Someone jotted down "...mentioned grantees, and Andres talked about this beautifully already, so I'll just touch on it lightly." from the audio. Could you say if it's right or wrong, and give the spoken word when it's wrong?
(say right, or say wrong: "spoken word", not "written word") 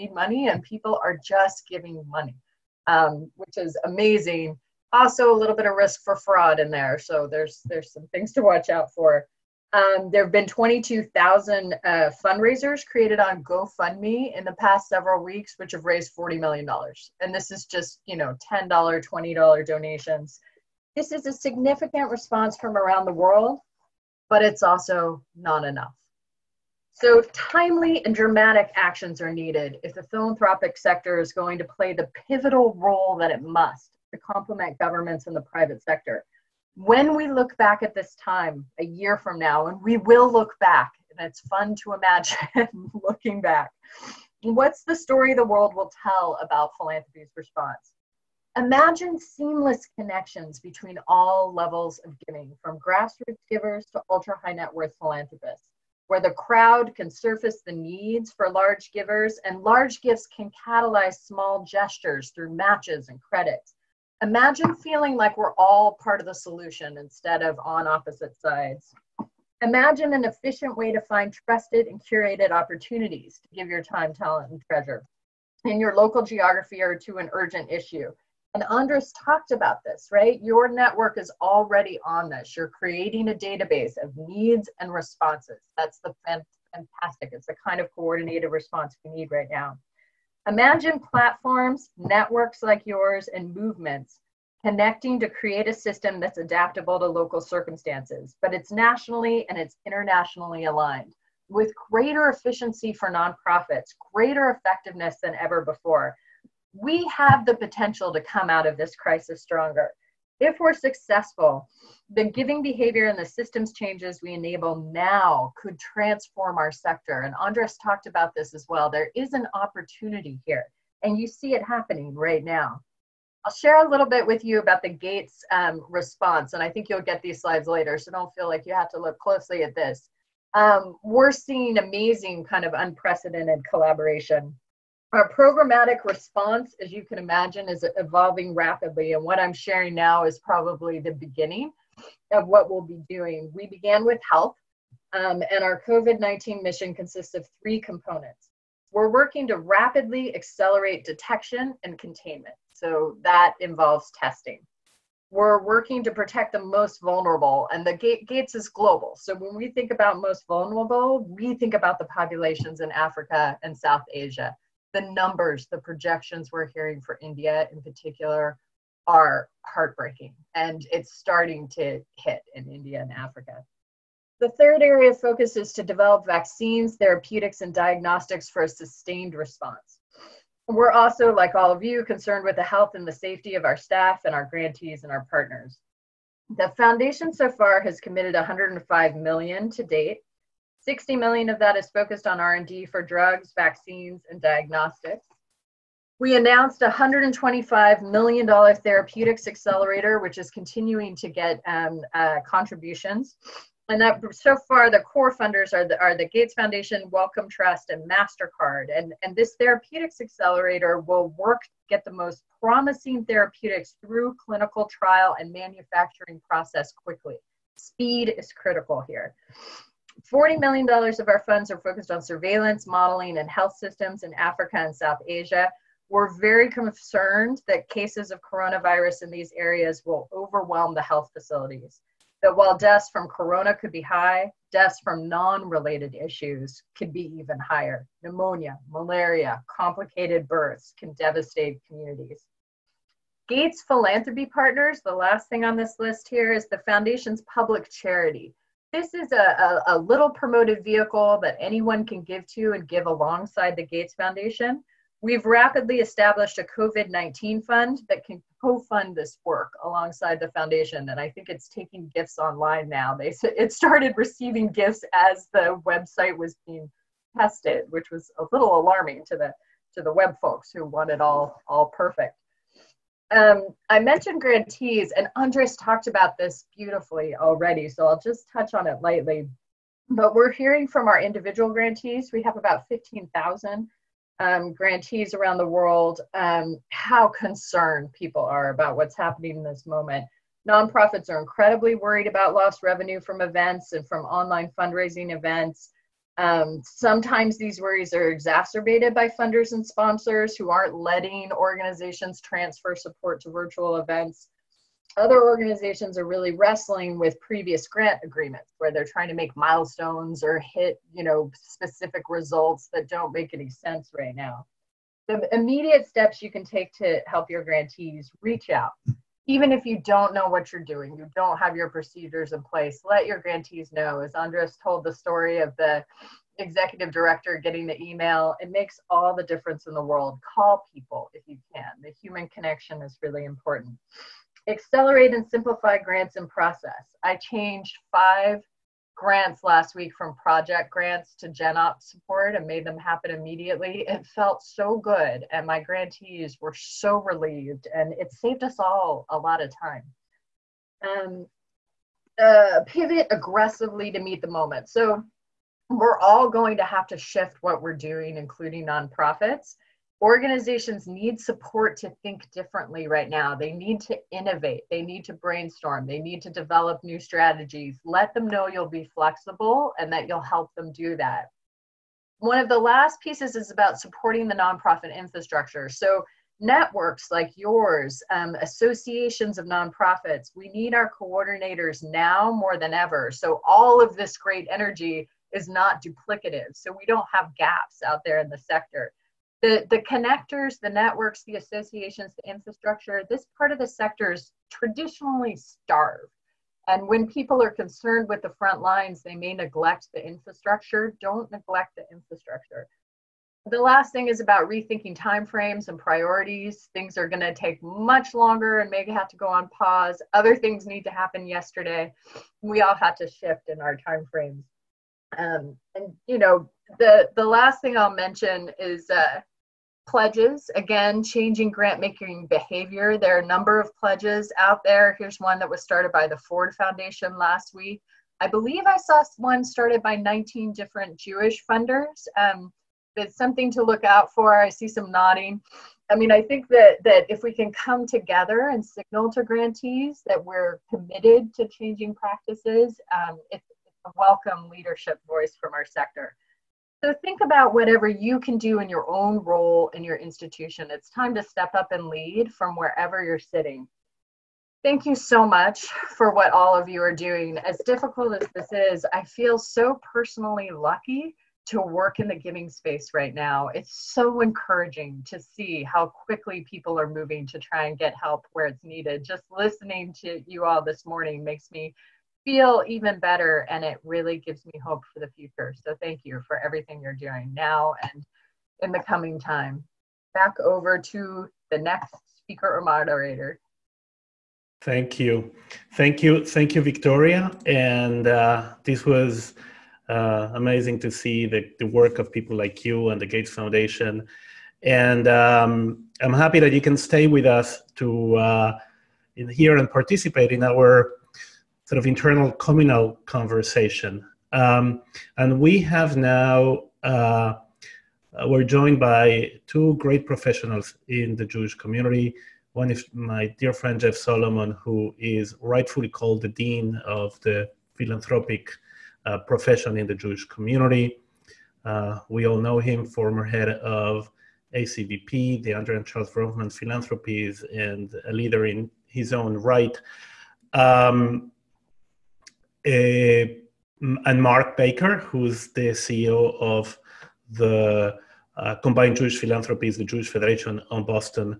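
right.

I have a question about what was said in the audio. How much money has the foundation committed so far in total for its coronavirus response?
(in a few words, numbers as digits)
105 million.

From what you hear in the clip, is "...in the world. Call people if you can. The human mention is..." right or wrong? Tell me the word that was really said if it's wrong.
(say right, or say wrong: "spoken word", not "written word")
wrong: "connection", not "mention".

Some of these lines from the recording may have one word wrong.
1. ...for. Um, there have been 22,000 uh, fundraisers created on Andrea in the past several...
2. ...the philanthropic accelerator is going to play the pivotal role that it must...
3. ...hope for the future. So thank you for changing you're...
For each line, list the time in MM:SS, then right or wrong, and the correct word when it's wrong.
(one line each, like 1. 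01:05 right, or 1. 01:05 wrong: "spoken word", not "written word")
1. 00:08 wrong: "GoFundMe", not "Andrea"
2. 00:29 wrong: "sector", not "accelerator"
3. 07:54 wrong: "everything", not "changing".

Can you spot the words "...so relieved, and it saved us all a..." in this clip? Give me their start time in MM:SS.
05:46.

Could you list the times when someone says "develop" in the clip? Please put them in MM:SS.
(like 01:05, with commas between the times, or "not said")
02:55, 06:06.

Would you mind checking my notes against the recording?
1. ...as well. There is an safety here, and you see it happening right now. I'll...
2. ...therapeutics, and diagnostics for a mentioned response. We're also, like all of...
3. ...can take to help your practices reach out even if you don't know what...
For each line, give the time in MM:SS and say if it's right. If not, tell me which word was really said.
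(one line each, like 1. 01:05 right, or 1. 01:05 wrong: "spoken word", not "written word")
1. 01:58 wrong: "opportunity", not "safety"
2. 02:56 wrong: "sustained", not "mentioned"
3. 05:16 wrong: "grantees", not "practices".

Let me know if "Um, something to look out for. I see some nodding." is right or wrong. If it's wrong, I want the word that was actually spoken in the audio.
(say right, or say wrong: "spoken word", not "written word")
right.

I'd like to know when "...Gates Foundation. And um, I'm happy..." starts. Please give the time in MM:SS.
08:13.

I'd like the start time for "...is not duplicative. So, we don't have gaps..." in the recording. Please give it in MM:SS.
06:25.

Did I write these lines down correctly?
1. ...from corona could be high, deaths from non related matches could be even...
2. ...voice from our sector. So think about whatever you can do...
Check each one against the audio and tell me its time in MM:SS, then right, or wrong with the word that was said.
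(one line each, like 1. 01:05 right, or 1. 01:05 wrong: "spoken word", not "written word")
1. 03:53 wrong: "issues", not "matches"
2. 07:25 right.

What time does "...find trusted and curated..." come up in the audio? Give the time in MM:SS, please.
01:11.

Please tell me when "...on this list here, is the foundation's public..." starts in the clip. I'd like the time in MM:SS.
04:05.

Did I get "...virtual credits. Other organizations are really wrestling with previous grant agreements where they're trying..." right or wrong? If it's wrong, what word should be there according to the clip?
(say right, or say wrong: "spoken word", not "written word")
wrong: "events", not "credits".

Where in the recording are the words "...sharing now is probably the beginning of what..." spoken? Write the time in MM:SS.
02:19.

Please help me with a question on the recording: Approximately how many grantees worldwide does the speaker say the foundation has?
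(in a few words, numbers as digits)
15,000.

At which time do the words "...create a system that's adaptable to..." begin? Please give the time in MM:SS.
01:35.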